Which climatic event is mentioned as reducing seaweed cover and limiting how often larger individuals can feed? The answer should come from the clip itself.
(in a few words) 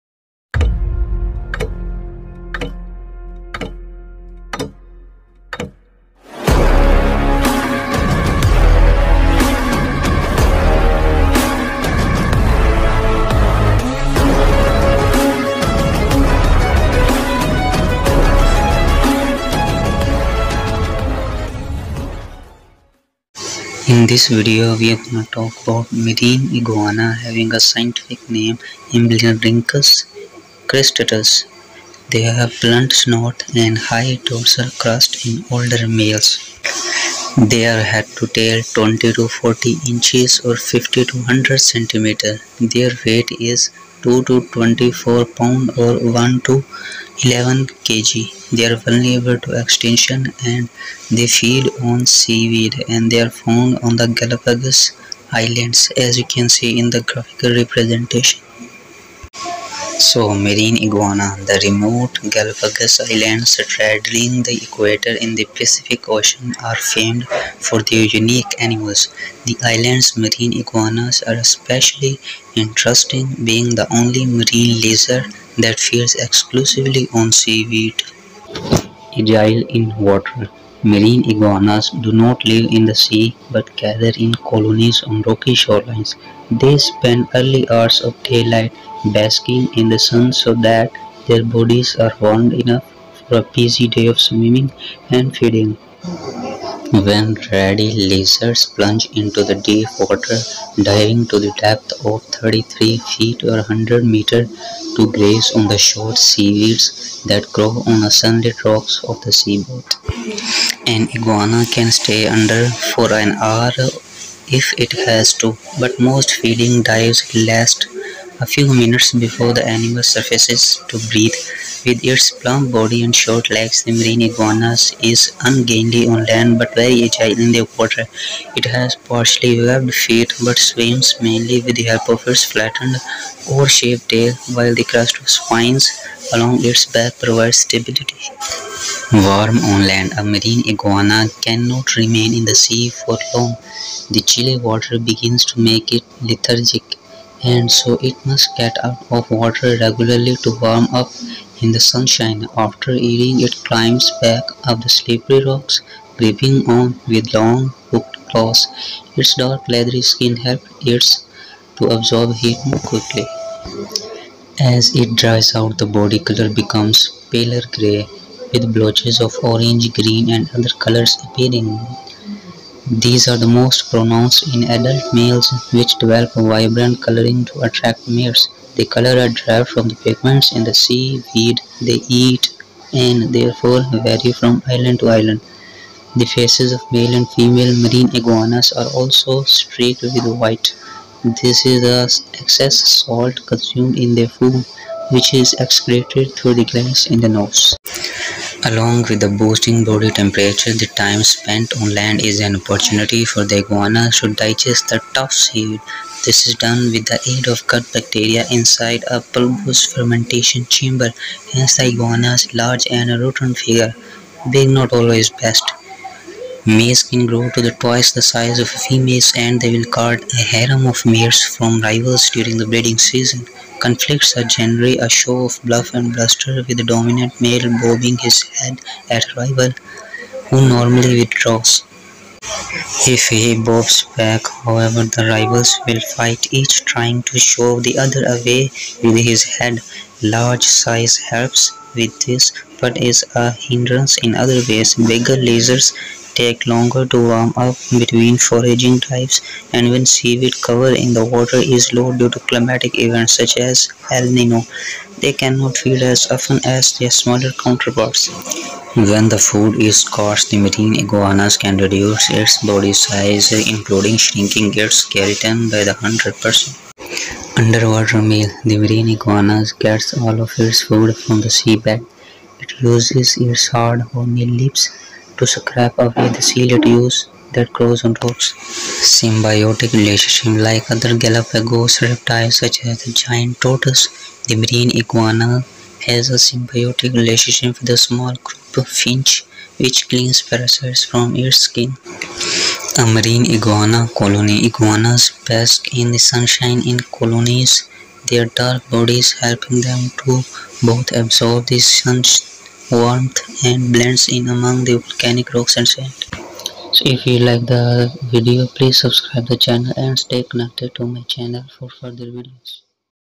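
El Nino.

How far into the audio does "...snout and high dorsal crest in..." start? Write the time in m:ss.
0:32.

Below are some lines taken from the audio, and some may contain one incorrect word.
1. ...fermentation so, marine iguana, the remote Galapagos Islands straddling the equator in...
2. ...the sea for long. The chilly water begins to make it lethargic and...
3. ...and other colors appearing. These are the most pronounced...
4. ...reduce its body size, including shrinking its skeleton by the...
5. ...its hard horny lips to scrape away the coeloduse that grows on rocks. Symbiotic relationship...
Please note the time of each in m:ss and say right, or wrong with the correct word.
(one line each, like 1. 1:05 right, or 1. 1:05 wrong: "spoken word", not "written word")
1. 0:57 wrong: "representation", not "fermentation"
2. 2:22 right
3. 2:50 right
4. 4:21 right
5. 4:33 right.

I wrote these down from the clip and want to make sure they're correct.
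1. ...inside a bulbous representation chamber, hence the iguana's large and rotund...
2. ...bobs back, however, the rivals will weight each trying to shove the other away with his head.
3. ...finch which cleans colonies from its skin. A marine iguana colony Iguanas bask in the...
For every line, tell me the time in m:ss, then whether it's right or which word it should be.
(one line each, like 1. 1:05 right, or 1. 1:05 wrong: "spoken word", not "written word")
1. 3:28 wrong: "fermentation", not "representation"
2. 3:53 wrong: "fight", not "weight"
3. 4:48 wrong: "parasites", not "colonies".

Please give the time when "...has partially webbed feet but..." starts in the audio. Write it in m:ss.
2:08.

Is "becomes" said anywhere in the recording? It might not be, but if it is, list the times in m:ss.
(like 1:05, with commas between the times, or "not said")
2:46.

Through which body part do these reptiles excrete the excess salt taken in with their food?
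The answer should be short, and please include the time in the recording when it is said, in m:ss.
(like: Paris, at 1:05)
nose, at 3:17.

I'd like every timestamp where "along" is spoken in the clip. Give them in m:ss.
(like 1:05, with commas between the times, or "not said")
2:16, 3:18.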